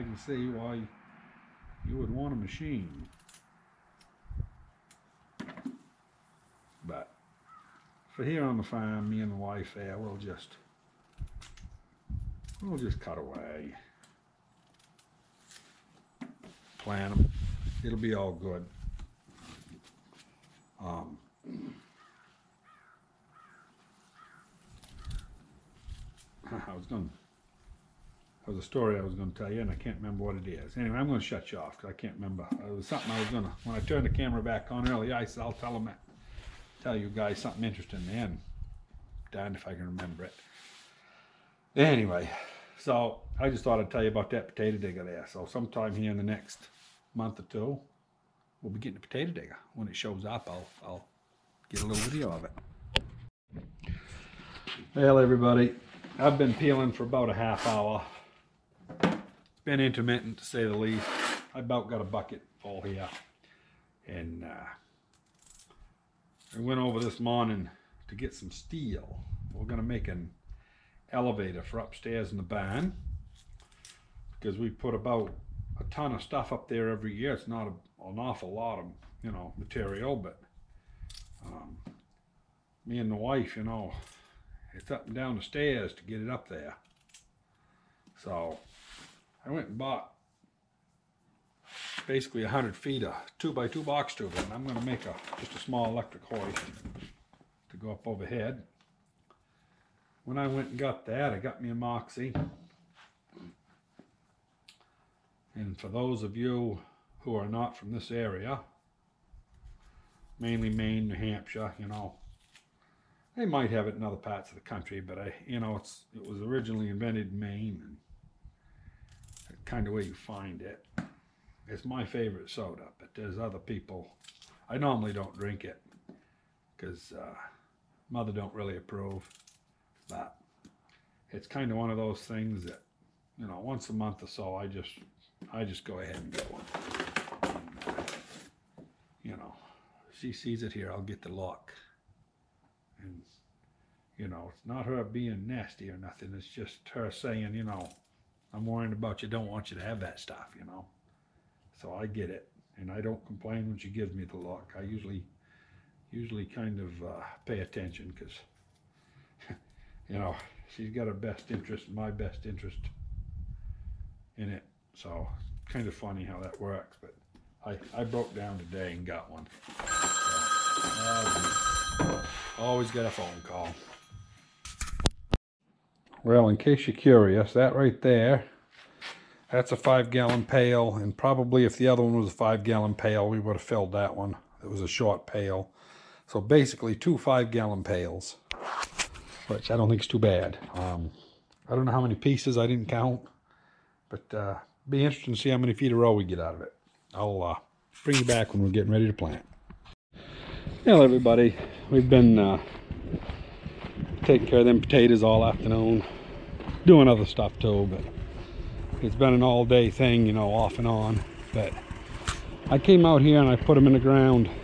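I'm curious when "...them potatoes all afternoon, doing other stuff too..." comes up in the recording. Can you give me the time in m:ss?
3:24.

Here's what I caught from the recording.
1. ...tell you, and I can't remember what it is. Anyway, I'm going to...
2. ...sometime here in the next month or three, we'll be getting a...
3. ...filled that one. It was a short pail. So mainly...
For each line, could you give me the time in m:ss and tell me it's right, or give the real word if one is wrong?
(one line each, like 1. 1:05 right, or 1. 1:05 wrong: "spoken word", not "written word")
1. 0:29 right
2. 0:45 wrong: "two", not "three"
3. 3:03 wrong: "basically", not "mainly".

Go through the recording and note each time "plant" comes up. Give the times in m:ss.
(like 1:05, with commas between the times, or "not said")
0:16, 3:19.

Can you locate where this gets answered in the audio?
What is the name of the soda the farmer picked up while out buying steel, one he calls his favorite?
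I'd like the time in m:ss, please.
1:41.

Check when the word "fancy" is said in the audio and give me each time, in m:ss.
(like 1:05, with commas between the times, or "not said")
not said.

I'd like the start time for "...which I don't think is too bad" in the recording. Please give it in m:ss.
3:09.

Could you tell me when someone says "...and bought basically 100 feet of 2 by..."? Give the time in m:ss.
1:29.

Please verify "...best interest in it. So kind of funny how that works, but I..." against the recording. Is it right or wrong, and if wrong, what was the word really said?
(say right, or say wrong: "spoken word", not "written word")
right.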